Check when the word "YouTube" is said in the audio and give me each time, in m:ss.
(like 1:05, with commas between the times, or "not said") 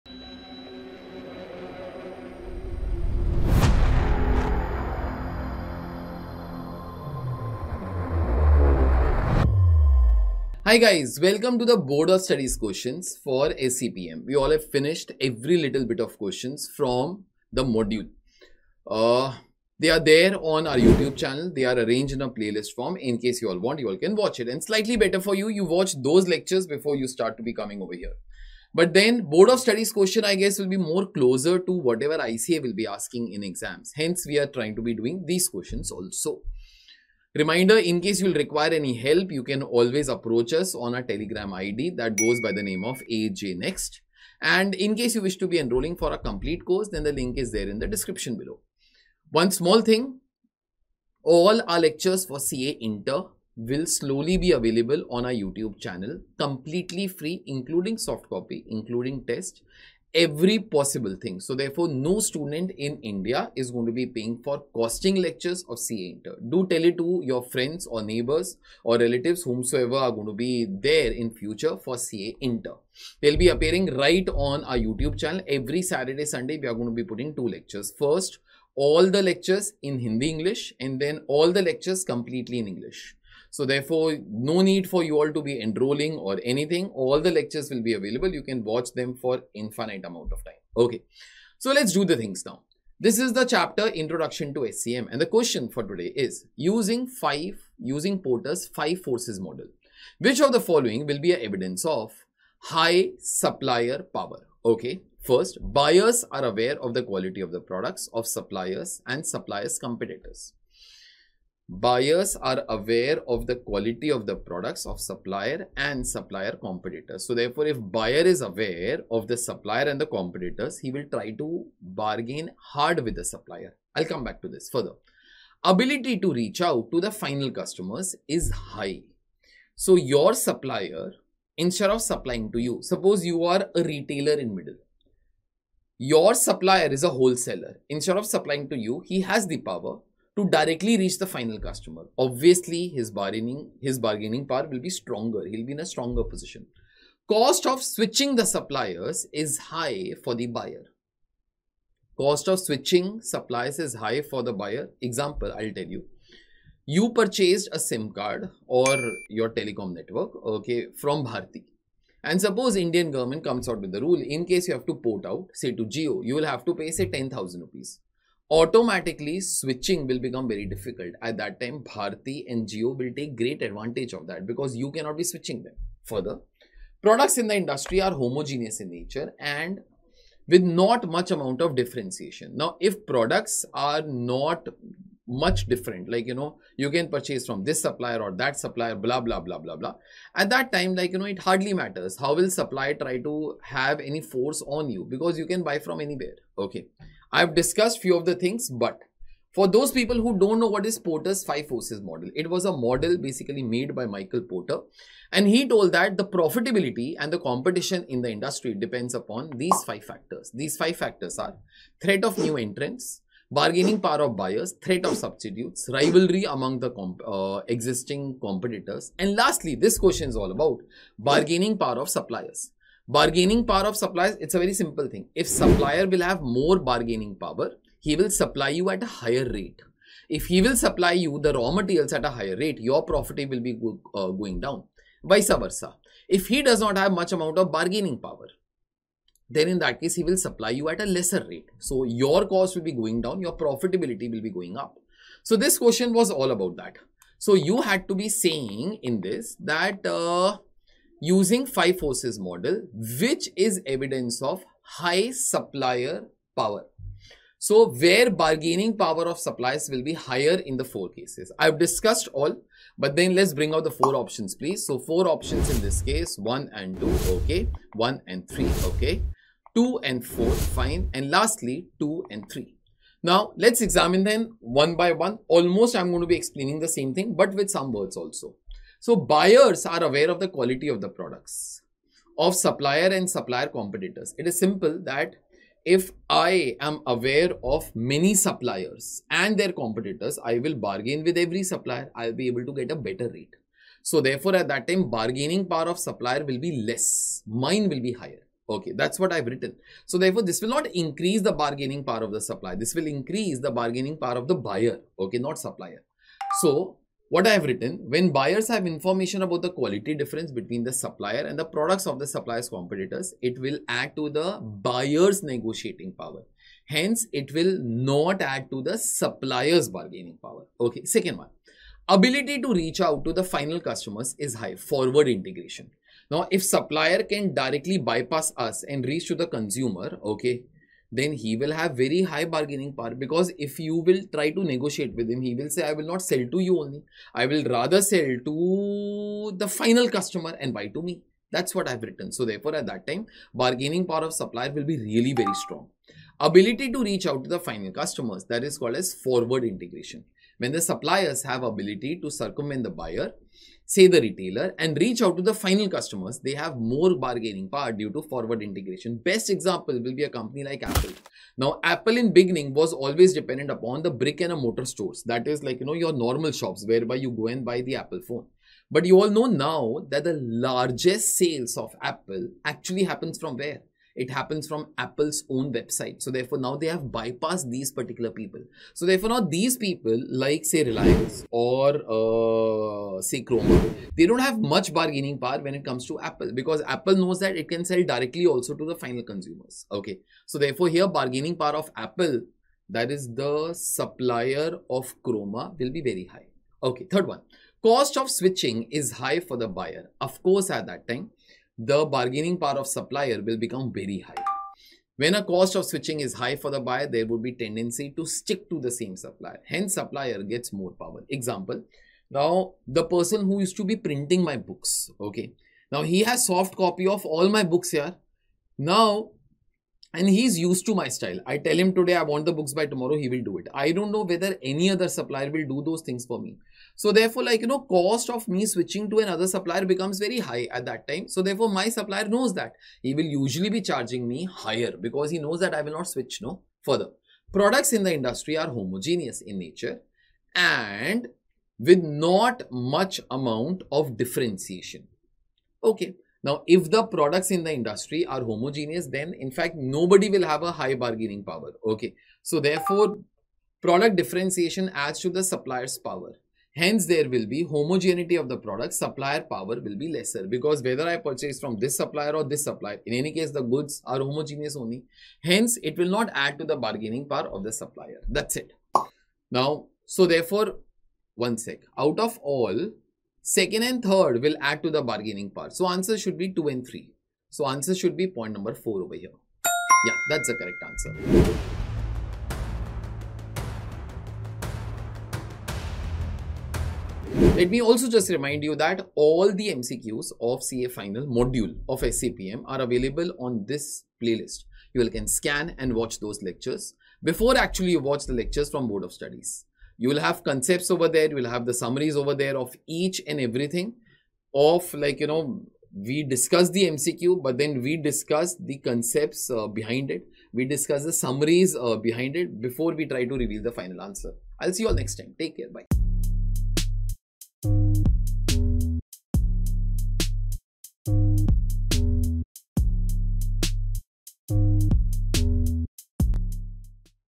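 0:20, 0:55, 1:14.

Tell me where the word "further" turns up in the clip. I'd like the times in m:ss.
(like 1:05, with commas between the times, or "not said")
2:04, 2:56, 7:16.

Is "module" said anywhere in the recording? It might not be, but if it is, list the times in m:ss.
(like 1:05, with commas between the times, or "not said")
0:17, 8:11.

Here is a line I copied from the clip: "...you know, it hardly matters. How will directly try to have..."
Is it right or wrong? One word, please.
wrong.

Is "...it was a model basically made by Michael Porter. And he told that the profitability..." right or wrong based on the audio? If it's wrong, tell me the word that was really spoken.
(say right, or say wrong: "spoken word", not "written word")
right.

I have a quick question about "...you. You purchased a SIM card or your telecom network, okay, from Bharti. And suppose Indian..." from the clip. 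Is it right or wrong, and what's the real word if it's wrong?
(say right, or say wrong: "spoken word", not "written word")
right.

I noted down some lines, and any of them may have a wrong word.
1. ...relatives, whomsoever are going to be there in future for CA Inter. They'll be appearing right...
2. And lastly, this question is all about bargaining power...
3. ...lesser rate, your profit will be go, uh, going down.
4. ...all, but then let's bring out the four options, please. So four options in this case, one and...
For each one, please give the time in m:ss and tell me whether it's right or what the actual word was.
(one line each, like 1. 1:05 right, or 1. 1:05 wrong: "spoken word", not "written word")
1. 1:08 right
2. 3:39 right
3. 3:52 wrong: "higher", not "lesser"
4. 4:22 right.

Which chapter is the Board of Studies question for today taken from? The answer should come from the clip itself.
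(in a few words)
Introduction to SCM.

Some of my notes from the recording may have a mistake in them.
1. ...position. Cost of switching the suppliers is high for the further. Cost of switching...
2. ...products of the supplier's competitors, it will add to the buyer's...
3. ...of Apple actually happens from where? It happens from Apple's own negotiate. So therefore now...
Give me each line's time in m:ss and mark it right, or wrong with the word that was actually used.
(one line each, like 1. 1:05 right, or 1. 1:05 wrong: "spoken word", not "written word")
1. 2:26 wrong: "buyer", not "further"
2. 5:11 right
3. 6:11 wrong: "website", not "negotiate".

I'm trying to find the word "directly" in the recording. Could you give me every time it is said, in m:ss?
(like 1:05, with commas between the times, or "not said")
2:20, 5:27, 6:28.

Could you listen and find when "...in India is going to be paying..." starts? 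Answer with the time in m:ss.
1:02.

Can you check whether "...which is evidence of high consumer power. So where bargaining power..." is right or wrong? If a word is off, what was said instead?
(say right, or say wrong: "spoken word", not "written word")
wrong: "supplier", not "consumer".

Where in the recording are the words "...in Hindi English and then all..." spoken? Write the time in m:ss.
1:19.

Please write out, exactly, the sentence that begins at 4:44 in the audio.
It is simple that if I am aware of many suppliers and their competitors, I will bargain with every supplier.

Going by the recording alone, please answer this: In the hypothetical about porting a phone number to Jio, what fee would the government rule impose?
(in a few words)
10,000 rupees.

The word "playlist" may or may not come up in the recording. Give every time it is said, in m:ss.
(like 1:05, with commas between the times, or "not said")
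0:22, 8:14.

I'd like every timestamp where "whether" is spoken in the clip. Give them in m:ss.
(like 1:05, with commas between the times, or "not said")
7:04, 7:40.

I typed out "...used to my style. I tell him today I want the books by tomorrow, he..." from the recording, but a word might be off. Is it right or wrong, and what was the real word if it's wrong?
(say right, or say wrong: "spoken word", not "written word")
right.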